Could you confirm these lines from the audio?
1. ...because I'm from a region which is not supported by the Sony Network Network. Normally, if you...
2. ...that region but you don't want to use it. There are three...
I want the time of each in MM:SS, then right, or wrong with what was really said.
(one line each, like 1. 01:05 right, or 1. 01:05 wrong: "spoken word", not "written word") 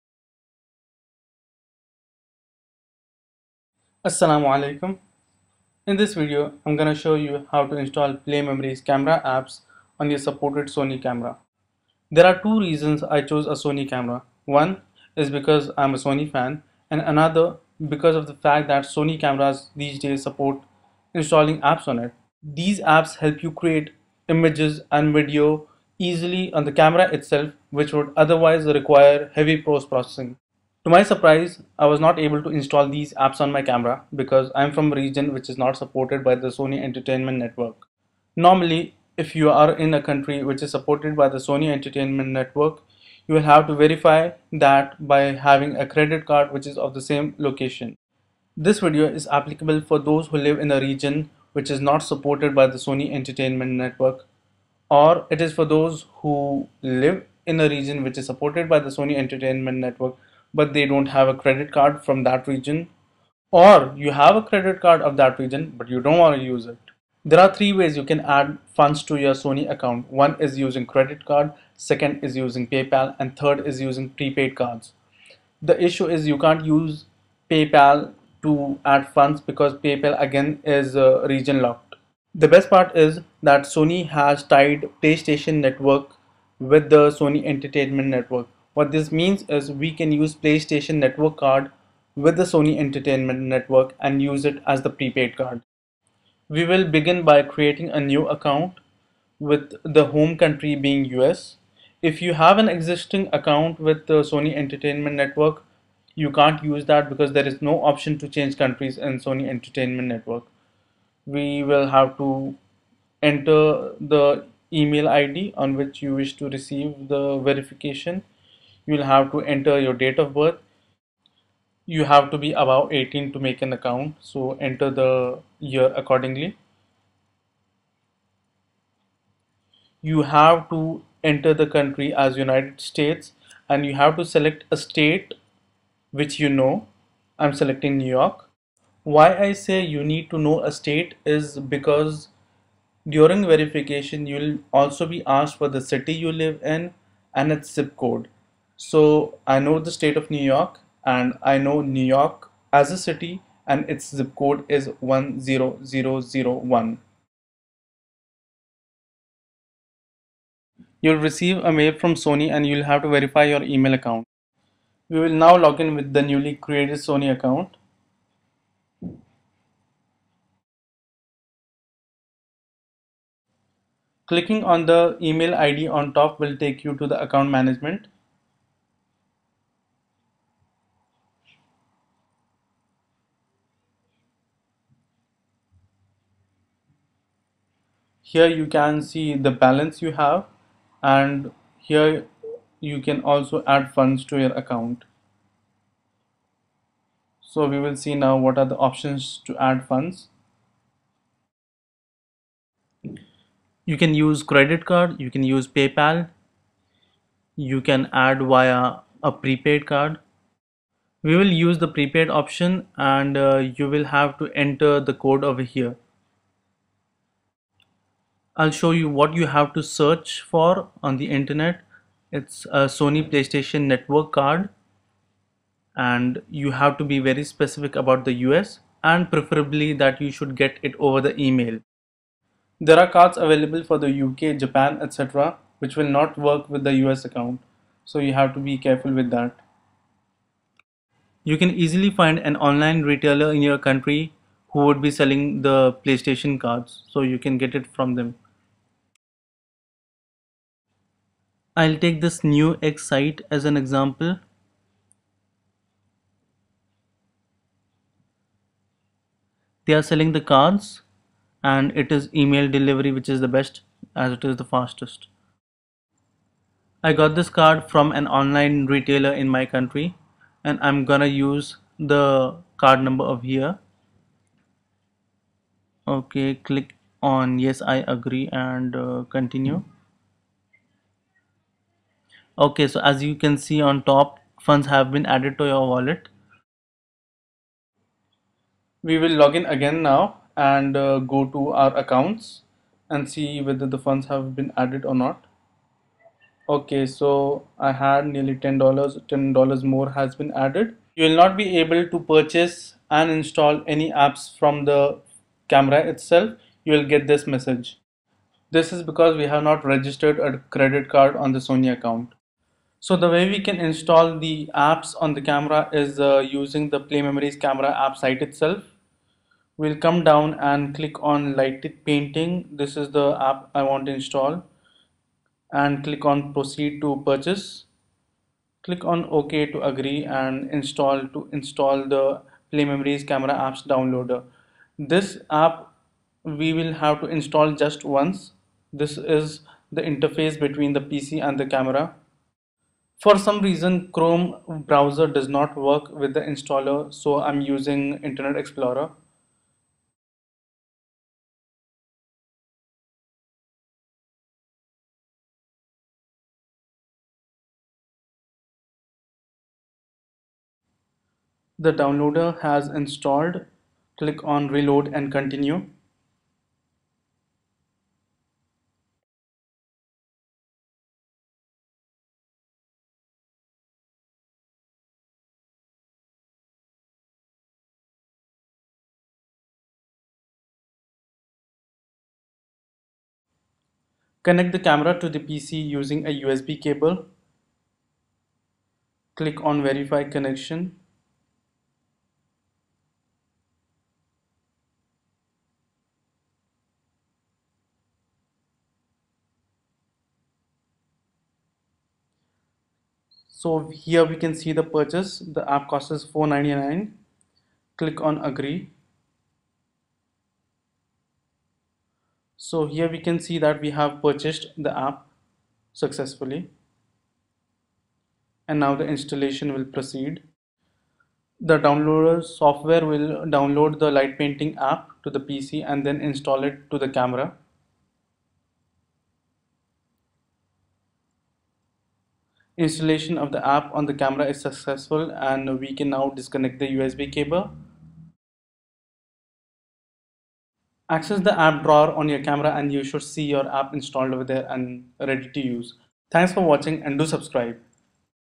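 1. 00:34 wrong: "Entertainment", not "Network"
2. 01:05 right.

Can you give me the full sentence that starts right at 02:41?
You'll receive a mail from Sony and you'll have to verify your email account.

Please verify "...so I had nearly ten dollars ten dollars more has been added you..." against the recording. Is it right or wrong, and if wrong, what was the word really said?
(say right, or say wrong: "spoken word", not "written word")
right.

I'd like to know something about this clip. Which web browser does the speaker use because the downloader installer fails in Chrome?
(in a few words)
Internet Explorer.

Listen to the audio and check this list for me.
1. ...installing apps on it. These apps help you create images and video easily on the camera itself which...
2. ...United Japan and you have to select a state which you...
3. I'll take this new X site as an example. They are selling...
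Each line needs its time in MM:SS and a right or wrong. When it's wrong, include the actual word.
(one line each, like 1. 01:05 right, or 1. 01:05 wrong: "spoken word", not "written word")
1. 00:21 right
2. 02:12 wrong: "States", not "Japan"
3. 04:11 right.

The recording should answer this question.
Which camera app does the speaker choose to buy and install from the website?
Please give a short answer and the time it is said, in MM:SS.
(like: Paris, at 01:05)
Light Painting, at 05:21.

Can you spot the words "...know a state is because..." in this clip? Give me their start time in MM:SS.
02:20.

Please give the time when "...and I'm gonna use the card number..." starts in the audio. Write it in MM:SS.
04:30.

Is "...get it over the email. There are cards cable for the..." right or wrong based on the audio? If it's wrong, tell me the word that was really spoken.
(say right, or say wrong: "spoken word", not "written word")
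wrong: "available", not "cable".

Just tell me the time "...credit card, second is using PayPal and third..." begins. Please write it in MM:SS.
01:10.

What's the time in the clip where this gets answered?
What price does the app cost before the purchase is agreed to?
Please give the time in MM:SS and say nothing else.
06:46.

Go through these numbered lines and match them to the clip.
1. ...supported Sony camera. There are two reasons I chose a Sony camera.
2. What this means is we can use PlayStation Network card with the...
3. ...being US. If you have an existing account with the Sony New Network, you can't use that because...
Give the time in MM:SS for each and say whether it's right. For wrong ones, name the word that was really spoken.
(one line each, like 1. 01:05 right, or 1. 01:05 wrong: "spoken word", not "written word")
1. 00:10 right
2. 01:28 right
3. 01:40 wrong: "Entertainment", not "New".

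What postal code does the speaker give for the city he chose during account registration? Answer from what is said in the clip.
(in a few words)
10001.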